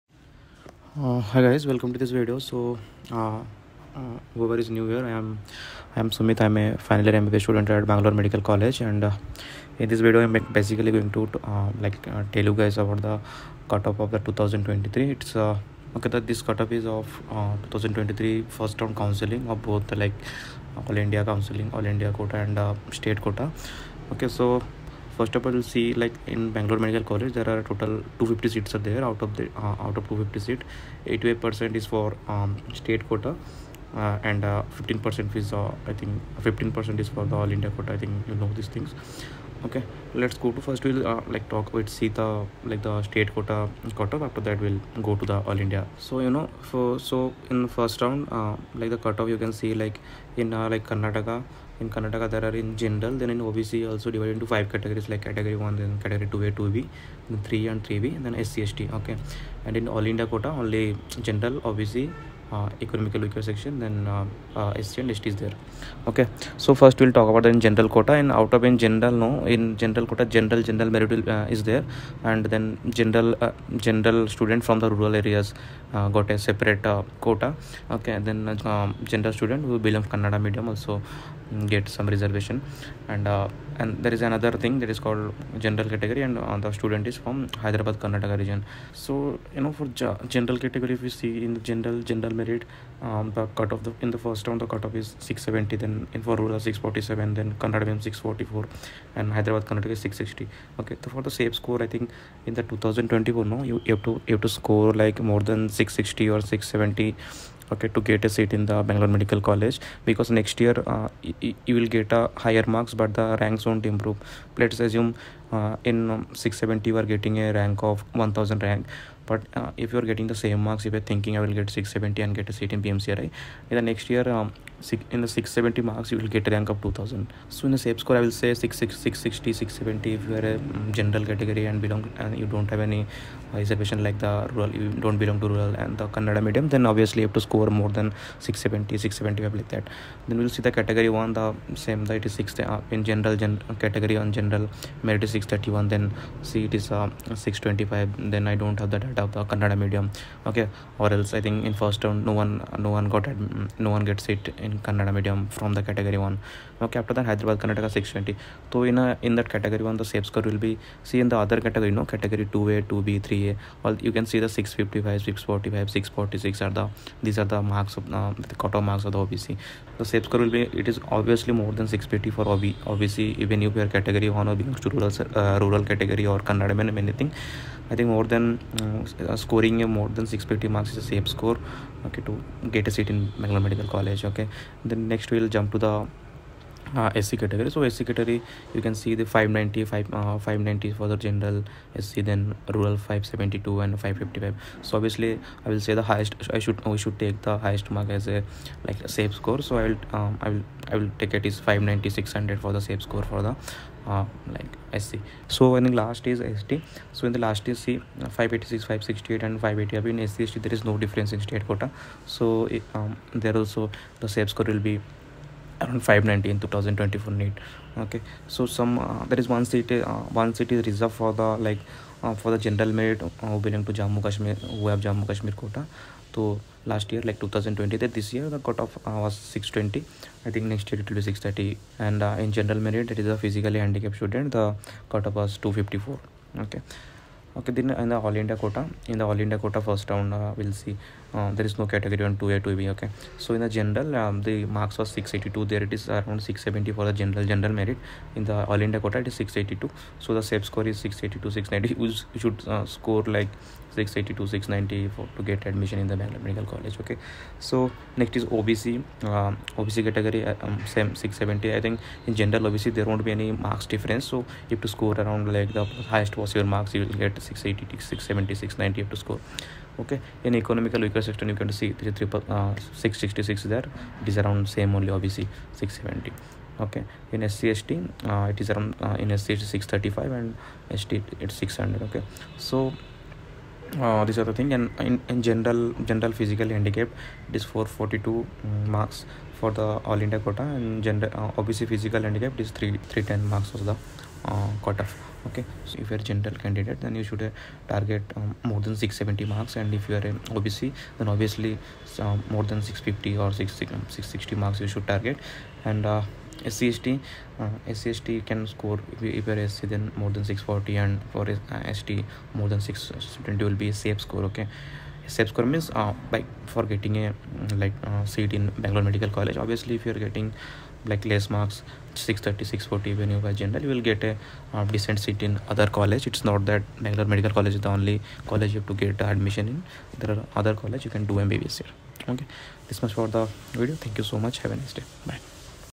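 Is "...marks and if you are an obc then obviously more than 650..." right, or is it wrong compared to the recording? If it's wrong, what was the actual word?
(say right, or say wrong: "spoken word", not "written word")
right.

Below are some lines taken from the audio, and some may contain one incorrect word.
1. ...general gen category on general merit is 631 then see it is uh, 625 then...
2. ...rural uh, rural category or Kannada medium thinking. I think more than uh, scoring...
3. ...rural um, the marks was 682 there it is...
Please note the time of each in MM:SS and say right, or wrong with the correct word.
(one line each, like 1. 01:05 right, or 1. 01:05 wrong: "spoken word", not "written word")
1. 02:23 right
2. 02:54 wrong: "anything", not "thinking"
3. 04:03 wrong: "general", not "rural".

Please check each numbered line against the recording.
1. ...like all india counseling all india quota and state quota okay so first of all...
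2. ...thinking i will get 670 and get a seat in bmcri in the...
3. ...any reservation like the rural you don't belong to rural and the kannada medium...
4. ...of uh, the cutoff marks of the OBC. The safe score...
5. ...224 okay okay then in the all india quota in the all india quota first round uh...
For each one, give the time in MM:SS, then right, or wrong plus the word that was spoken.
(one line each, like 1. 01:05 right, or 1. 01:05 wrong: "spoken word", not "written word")
1. 00:19 right
2. 02:01 right
3. 02:12 right
4. 02:47 right
5. 03:55 wrong: "254", not "224".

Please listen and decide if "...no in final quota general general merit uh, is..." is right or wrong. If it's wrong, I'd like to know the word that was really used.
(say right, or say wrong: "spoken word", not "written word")
wrong: "general", not "final".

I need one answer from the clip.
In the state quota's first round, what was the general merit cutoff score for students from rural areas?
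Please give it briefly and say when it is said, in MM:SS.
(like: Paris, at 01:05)
647, at 01:36.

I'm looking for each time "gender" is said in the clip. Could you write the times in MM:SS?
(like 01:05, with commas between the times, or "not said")
01:19, 04:51.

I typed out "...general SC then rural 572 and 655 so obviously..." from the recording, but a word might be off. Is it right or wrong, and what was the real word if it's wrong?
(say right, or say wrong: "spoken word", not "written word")
wrong: "555", not "655".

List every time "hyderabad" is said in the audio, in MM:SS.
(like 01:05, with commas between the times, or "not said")
01:27, 01:39, 02:37.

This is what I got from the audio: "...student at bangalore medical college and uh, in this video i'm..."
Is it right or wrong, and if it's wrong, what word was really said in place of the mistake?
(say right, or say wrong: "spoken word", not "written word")
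right.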